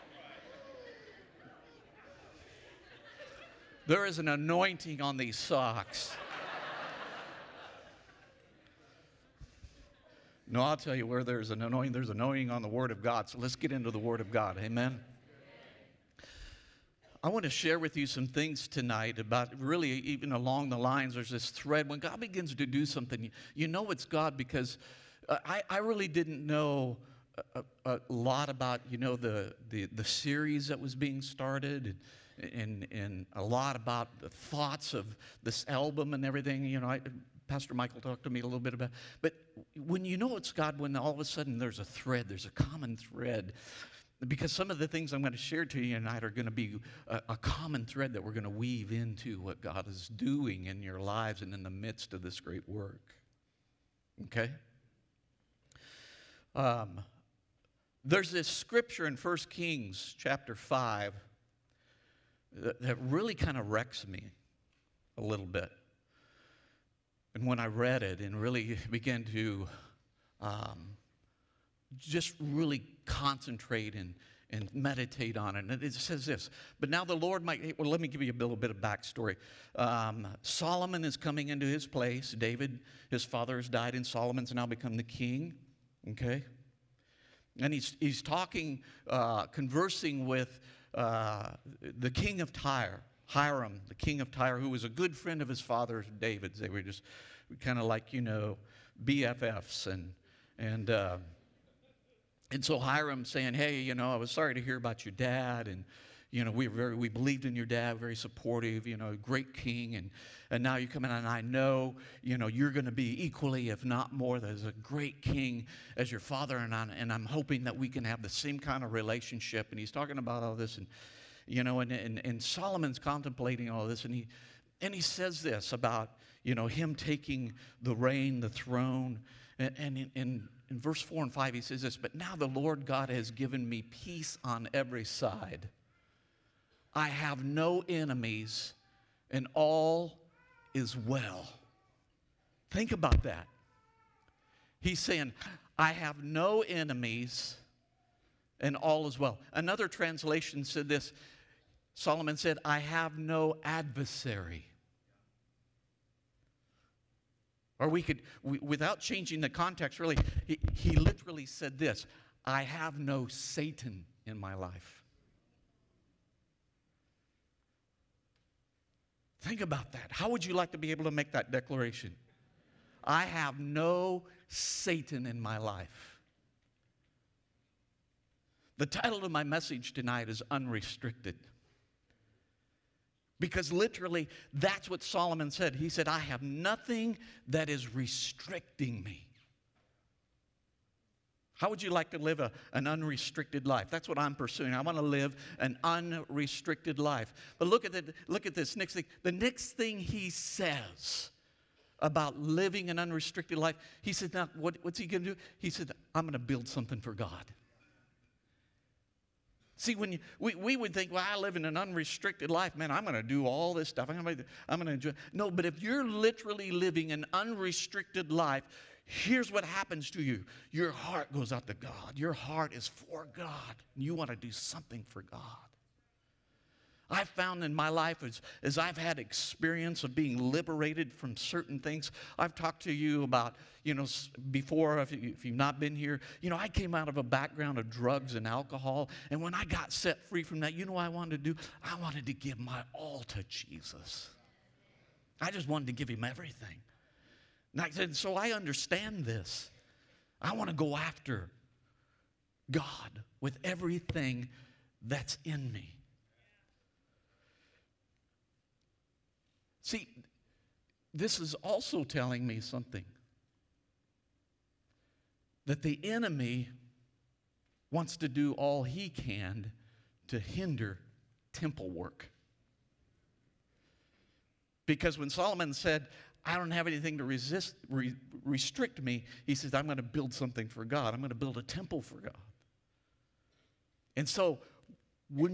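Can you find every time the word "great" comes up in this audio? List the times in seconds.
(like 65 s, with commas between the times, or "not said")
52 s, 109 s, 114 s.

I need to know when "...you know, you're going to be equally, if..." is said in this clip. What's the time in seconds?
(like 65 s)
112 s.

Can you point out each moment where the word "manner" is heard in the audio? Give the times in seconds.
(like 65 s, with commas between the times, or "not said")
not said.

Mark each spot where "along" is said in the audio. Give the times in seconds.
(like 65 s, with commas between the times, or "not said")
20 s.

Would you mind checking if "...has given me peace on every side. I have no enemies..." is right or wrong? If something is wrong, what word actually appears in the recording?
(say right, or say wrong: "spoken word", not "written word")
right.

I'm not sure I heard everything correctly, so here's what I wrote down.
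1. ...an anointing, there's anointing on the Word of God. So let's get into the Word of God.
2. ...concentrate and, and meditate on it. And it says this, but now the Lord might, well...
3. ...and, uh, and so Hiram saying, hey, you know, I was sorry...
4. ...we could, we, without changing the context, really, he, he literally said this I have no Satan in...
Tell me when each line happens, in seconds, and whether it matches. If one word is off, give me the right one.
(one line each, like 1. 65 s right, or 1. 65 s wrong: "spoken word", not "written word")
1. 11 s right
2. 73 s right
3. 100 s right
4. 157 s right.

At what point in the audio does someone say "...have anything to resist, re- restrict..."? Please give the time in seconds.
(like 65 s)
276 s.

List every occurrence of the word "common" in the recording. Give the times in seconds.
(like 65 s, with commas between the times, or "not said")
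42 s, 47 s.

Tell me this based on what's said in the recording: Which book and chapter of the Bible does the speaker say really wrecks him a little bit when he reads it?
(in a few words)
1 Kings 5.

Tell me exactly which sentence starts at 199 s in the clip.
The next thing he says about living an unrestricted life, he said, Now, what, what's he going to do?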